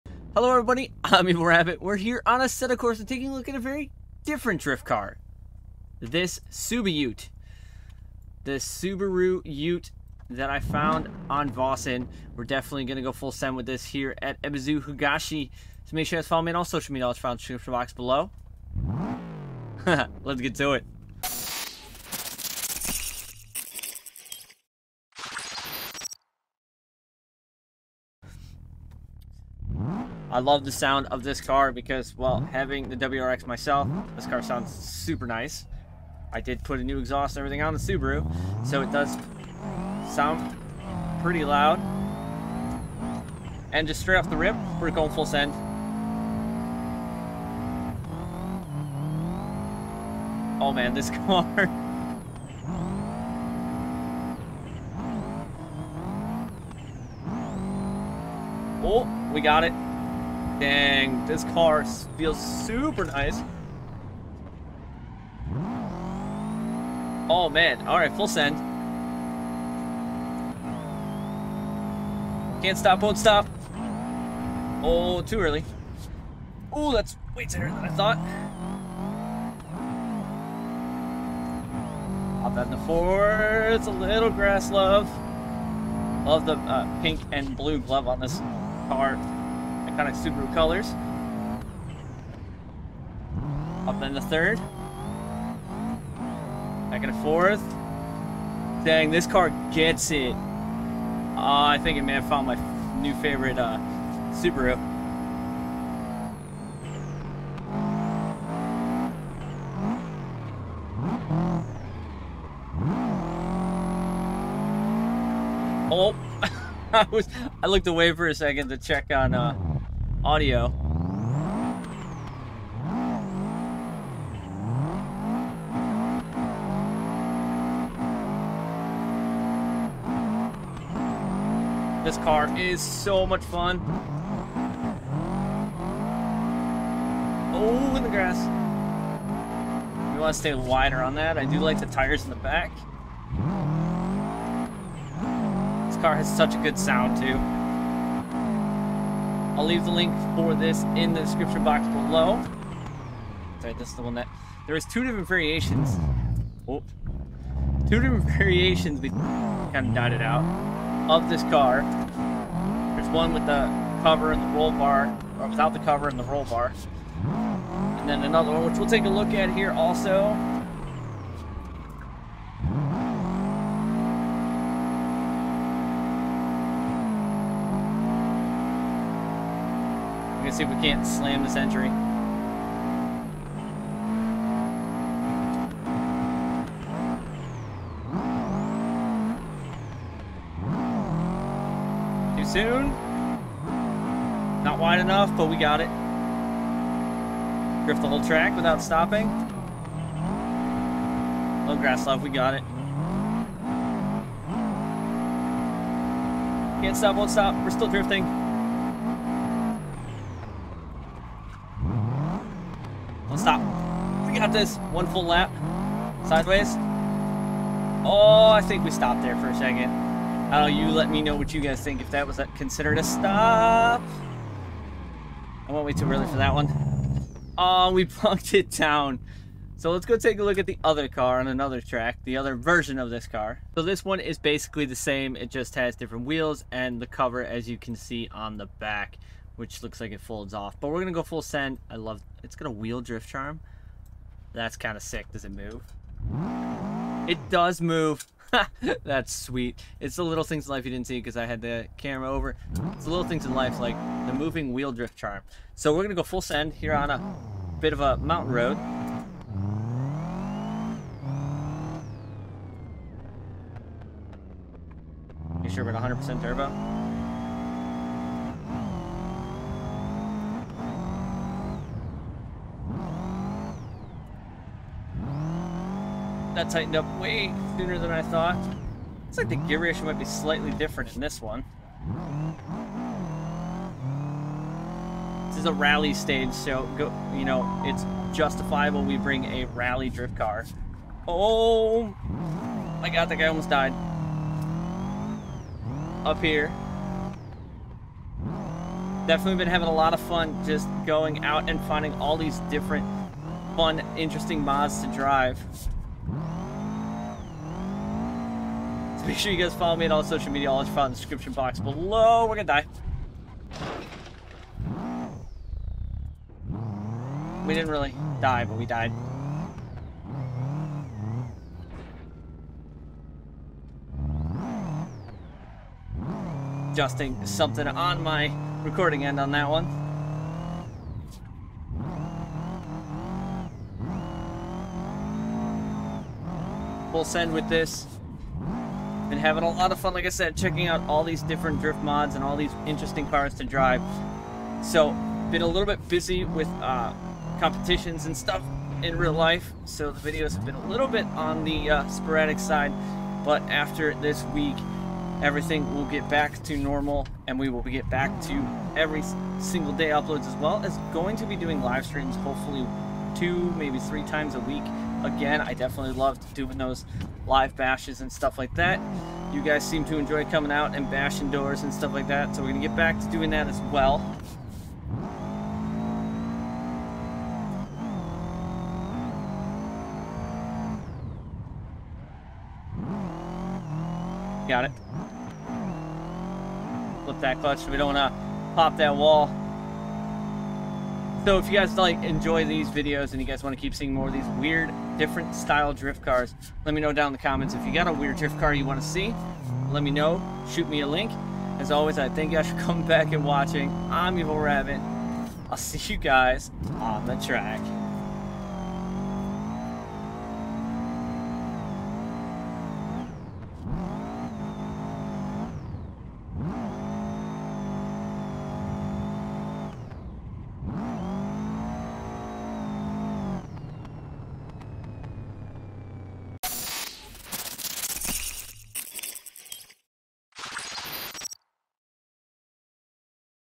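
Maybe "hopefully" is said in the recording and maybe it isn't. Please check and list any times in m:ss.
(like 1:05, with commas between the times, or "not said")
6:02.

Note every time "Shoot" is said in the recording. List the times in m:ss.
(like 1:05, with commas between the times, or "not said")
6:40.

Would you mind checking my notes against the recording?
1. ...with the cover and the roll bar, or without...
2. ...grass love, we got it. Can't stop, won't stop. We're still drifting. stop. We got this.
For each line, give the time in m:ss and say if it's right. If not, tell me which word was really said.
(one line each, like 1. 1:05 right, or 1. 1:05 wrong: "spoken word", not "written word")
1. 2:43 right
2. 3:21 right.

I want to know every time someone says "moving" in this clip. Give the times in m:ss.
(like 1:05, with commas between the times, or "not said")
4:14.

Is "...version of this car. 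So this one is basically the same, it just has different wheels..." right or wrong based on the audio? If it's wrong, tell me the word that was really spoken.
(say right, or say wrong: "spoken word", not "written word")
right.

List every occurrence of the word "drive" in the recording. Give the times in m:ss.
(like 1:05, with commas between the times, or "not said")
5:05, 5:43.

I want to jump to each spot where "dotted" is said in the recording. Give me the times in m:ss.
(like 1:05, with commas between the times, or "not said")
2:39.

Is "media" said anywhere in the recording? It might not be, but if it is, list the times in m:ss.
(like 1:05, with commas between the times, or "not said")
0:16, 5:10.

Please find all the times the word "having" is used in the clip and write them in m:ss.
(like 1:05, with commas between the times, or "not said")
0:32, 4:59, 5:39.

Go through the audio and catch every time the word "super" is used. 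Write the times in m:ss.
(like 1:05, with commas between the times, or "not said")
0:34, 1:02.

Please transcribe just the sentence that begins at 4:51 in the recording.
Oh my god, that guy almost died.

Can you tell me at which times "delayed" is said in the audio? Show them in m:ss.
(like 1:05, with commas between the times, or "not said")
not said.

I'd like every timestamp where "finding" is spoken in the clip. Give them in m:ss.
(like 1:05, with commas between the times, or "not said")
5:01.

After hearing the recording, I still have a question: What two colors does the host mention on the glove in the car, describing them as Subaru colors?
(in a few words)
Pink and blue.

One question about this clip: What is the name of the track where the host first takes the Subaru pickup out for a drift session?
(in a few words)
Ebisu Higashi.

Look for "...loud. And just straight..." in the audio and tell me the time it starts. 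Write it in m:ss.
0:41.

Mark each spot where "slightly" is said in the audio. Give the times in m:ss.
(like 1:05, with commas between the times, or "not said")
4:40.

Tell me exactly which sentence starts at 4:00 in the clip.
But we're gonna go full send.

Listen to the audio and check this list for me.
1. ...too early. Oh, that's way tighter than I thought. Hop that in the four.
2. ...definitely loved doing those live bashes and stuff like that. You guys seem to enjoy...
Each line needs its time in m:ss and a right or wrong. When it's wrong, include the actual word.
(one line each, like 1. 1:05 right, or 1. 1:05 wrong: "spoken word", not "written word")
1. 1:15 right
2. 6:05 right.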